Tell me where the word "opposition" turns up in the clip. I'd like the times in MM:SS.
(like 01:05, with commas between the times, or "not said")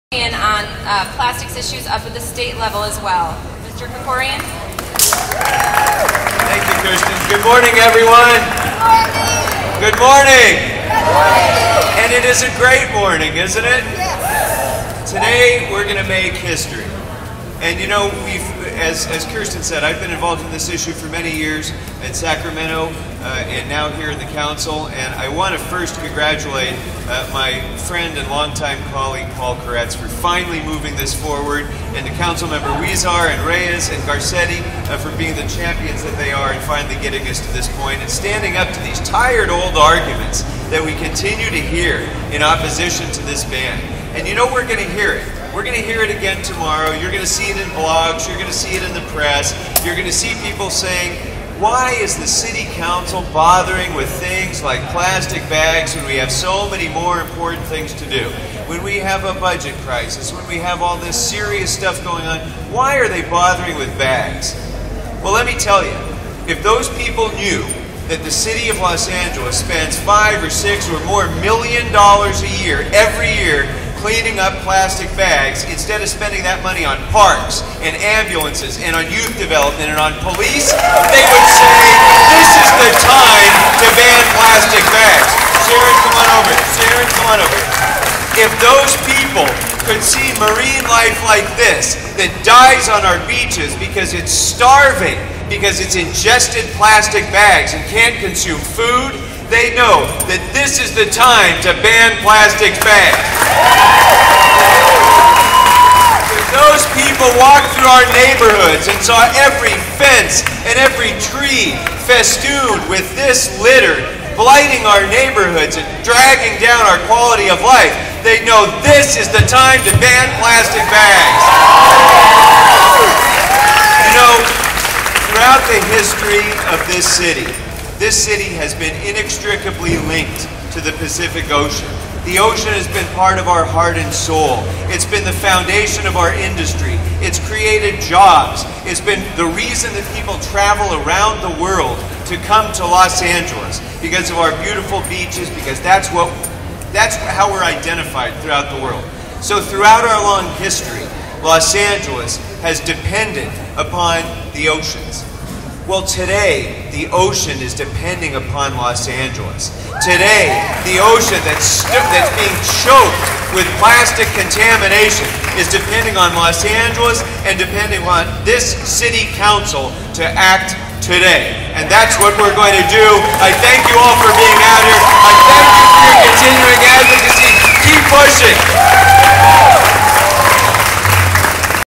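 00:42.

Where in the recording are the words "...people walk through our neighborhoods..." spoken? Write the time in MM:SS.
01:46.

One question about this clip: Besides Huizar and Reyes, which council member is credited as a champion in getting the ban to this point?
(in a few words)
Garcetti.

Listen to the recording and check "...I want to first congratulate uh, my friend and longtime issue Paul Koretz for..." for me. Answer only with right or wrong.
wrong.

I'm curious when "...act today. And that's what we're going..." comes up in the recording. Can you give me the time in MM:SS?
02:50.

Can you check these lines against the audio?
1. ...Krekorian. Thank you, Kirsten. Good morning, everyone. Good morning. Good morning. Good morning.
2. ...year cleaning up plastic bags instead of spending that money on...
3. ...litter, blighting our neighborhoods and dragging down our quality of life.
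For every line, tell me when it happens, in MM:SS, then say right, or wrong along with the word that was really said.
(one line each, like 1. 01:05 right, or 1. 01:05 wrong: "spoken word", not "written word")
1. 00:03 right
2. 01:13 right
3. 01:53 right.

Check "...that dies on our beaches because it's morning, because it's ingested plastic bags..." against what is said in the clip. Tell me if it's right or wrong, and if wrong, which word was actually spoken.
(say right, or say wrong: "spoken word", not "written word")
wrong: "starving", not "morning".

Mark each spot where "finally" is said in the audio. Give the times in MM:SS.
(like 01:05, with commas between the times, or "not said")
00:30, 00:36.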